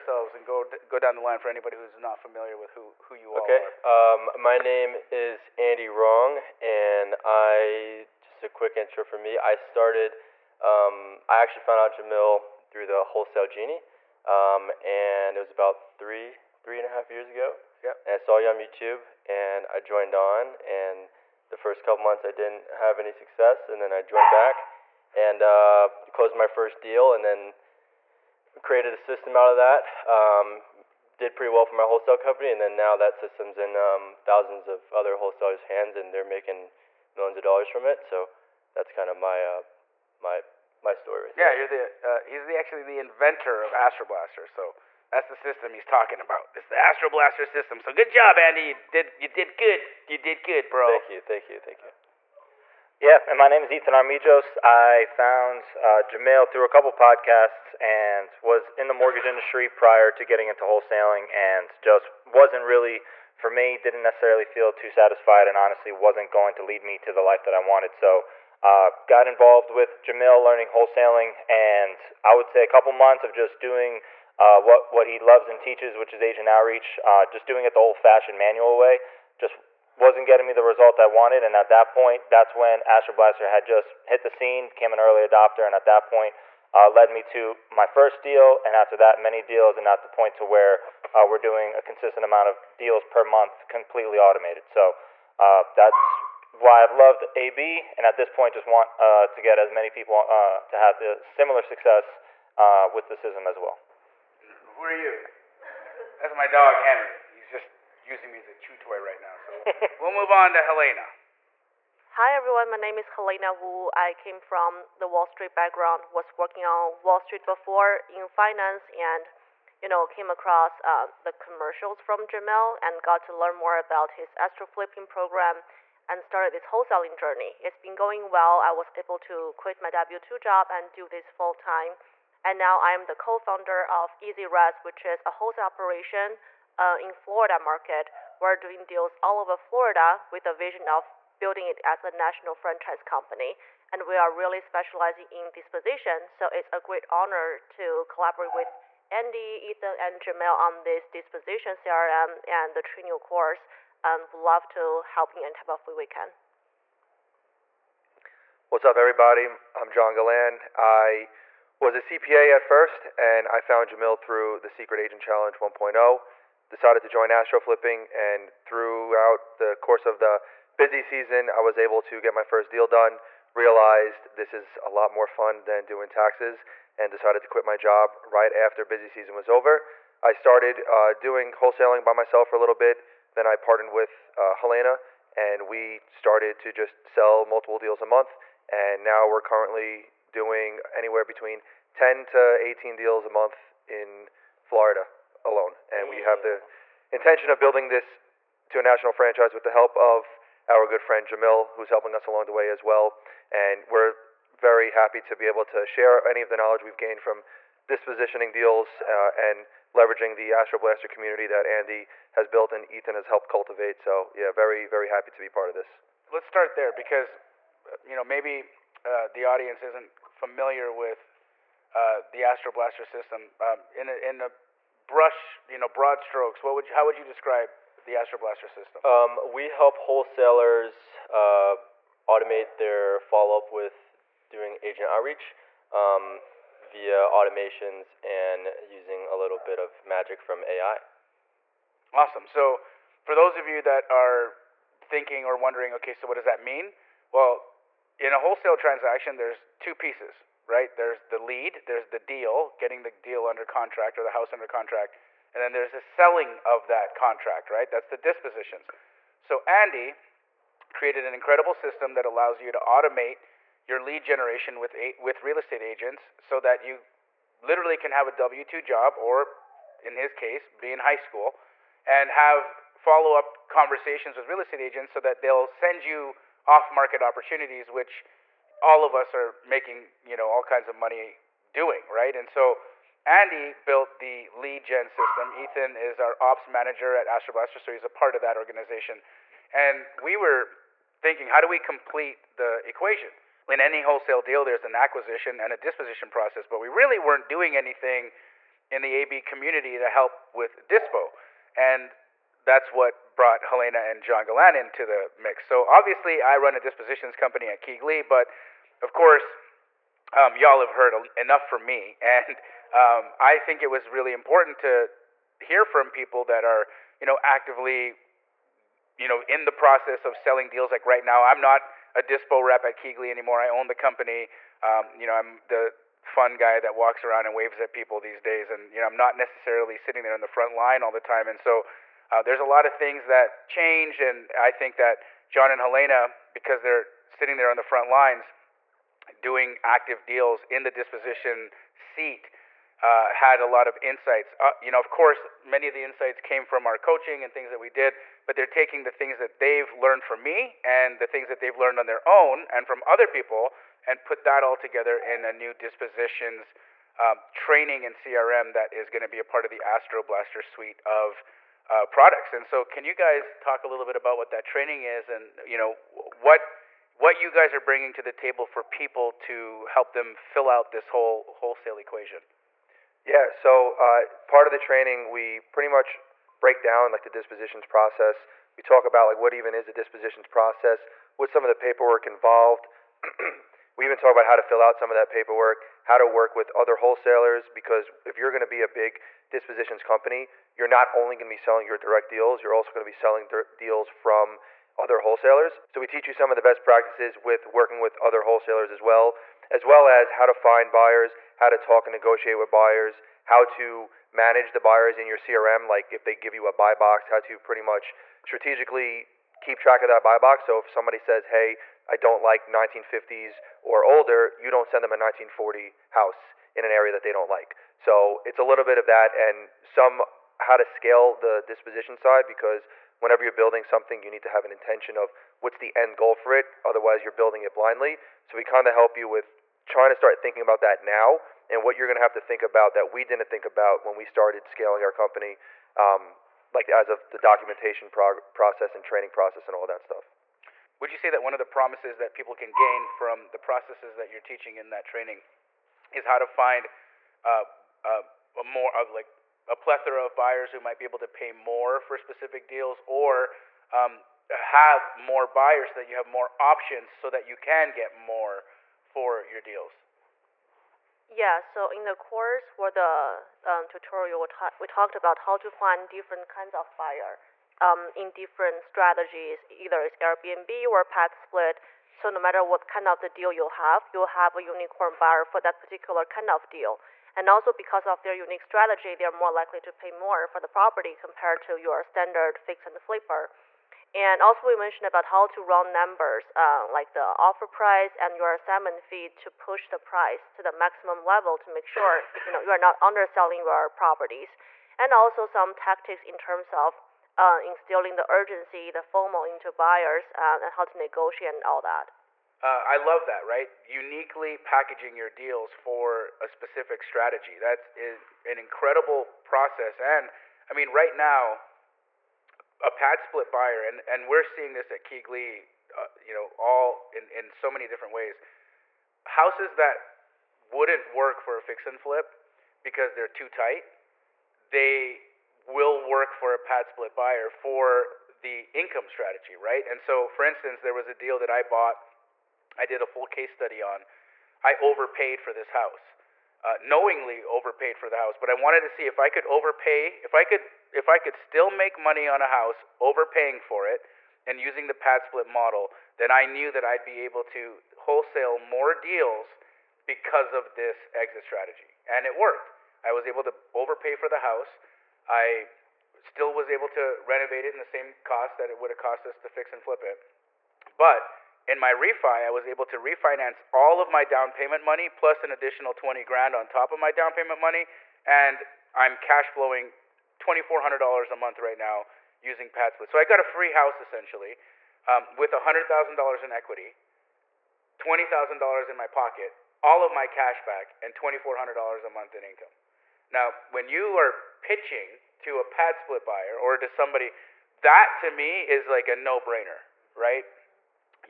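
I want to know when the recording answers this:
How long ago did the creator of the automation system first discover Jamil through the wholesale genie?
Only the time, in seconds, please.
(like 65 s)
15 s.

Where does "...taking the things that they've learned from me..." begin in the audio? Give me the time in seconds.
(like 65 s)
348 s.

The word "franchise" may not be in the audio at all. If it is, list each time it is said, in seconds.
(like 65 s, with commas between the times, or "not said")
142 s, 199 s.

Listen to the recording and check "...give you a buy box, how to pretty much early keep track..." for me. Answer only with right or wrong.
wrong.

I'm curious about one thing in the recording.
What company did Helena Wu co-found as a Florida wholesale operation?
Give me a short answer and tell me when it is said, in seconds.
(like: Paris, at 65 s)
Easy Res, at 134 s.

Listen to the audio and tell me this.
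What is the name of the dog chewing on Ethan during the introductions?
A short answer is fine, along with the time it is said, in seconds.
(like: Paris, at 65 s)
Henry, at 106 s.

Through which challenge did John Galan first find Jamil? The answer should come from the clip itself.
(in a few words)
Secret Agent Challenge 1.0.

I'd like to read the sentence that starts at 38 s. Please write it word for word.
So that's kind of my uh, my my story.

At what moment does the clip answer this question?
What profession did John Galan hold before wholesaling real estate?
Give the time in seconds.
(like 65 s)
161 s.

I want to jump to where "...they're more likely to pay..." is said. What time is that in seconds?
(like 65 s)
479 s.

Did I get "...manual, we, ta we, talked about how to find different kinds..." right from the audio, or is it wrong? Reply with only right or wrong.
wrong.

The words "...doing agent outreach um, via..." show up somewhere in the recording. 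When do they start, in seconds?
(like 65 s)
234 s.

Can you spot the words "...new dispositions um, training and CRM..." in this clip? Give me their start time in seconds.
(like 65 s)
355 s.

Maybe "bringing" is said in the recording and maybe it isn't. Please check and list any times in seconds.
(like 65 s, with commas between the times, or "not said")
367 s.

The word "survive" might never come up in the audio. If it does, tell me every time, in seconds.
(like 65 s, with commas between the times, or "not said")
not said.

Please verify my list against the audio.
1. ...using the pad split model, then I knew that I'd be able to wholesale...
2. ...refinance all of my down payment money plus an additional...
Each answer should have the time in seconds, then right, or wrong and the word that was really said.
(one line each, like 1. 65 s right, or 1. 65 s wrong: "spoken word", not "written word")
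1. 544 s right
2. 562 s right.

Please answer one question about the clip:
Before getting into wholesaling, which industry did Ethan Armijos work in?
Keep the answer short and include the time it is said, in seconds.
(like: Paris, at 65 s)
Mortgage industry, at 58 s.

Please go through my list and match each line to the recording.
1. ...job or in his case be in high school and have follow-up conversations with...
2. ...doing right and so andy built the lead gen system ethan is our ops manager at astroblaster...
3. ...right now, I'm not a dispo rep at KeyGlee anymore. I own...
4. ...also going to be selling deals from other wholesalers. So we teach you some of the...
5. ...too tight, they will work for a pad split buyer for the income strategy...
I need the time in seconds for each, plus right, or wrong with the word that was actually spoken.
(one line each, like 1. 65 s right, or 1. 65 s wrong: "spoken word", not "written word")
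1. 268 s right
2. 281 s right
3. 321 s right
4. 392 s right
5. 523 s right.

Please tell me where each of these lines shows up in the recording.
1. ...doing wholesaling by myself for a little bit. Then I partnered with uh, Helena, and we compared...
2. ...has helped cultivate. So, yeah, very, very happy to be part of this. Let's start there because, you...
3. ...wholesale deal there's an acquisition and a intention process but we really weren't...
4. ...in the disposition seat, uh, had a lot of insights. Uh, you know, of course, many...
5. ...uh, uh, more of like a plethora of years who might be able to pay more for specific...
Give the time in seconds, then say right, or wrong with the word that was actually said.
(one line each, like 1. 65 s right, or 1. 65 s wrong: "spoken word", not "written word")
1. 181 s wrong: "started", not "compared"
2. 213 s right
3. 294 s wrong: "disposition", not "intention"
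4. 340 s right
5. 447 s wrong: "buyers", not "years".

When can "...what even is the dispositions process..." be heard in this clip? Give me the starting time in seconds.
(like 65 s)
379 s.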